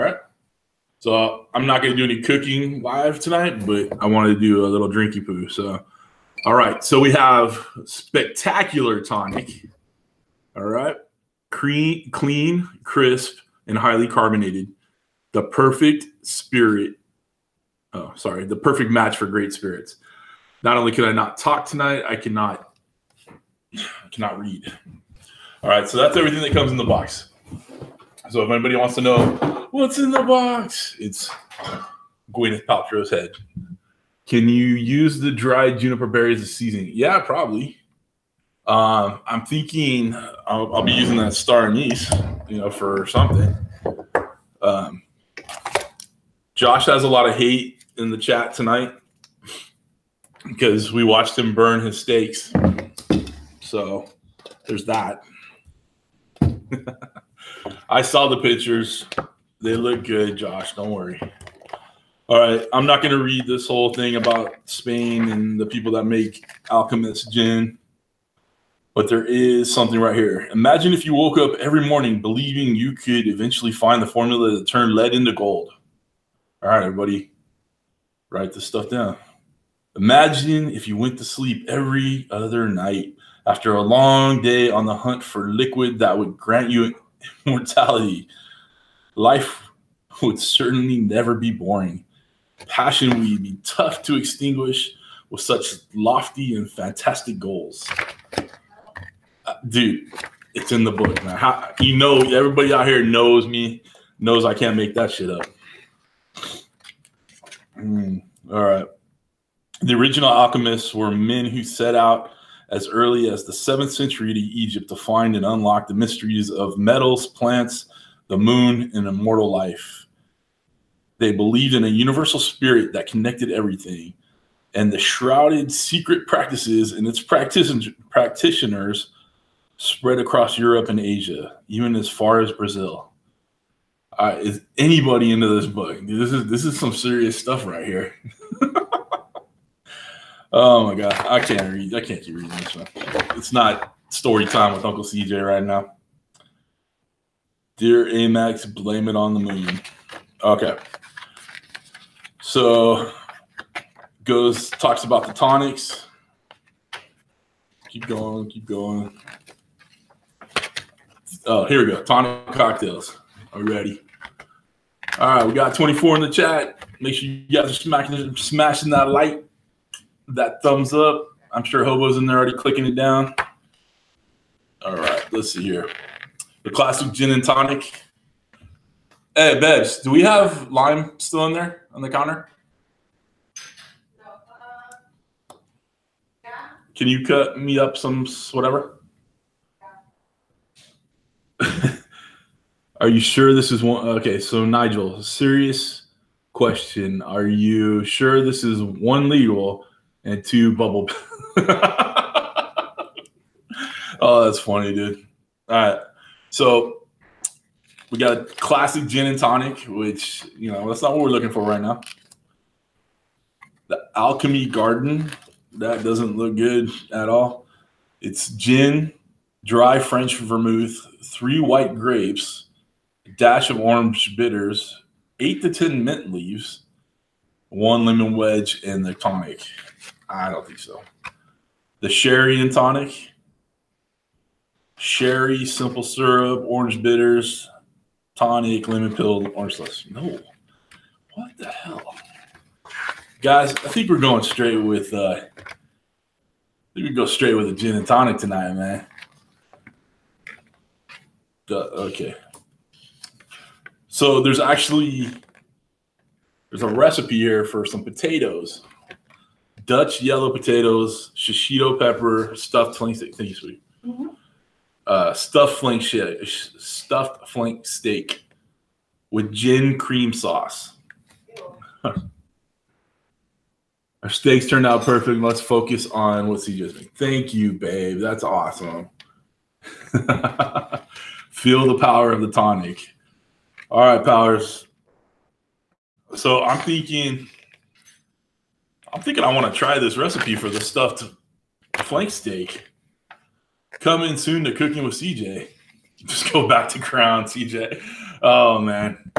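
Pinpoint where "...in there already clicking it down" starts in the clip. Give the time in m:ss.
2:52.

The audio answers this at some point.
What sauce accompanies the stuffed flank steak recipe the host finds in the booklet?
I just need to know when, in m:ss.
4:29.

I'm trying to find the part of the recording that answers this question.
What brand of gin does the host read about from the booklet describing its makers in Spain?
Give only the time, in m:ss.
1:06.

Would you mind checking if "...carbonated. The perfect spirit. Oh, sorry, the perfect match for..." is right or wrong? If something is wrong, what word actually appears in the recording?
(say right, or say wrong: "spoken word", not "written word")
right.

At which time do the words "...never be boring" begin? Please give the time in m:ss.
1:30.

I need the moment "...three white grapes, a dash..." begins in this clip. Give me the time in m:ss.
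3:41.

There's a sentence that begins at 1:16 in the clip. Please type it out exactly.
All right, everybody, write this stuff down.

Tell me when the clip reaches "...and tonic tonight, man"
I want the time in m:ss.
4:07.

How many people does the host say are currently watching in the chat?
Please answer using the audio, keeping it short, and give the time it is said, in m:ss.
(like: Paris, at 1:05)
24, at 2:45.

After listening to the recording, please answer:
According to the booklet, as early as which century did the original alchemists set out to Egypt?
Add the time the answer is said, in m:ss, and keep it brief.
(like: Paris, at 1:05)
7th century, at 1:53.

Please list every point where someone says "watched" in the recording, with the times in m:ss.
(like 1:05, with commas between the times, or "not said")
0:51.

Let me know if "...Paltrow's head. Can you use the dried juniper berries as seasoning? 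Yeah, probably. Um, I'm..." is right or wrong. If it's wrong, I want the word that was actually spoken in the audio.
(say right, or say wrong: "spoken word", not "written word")
right.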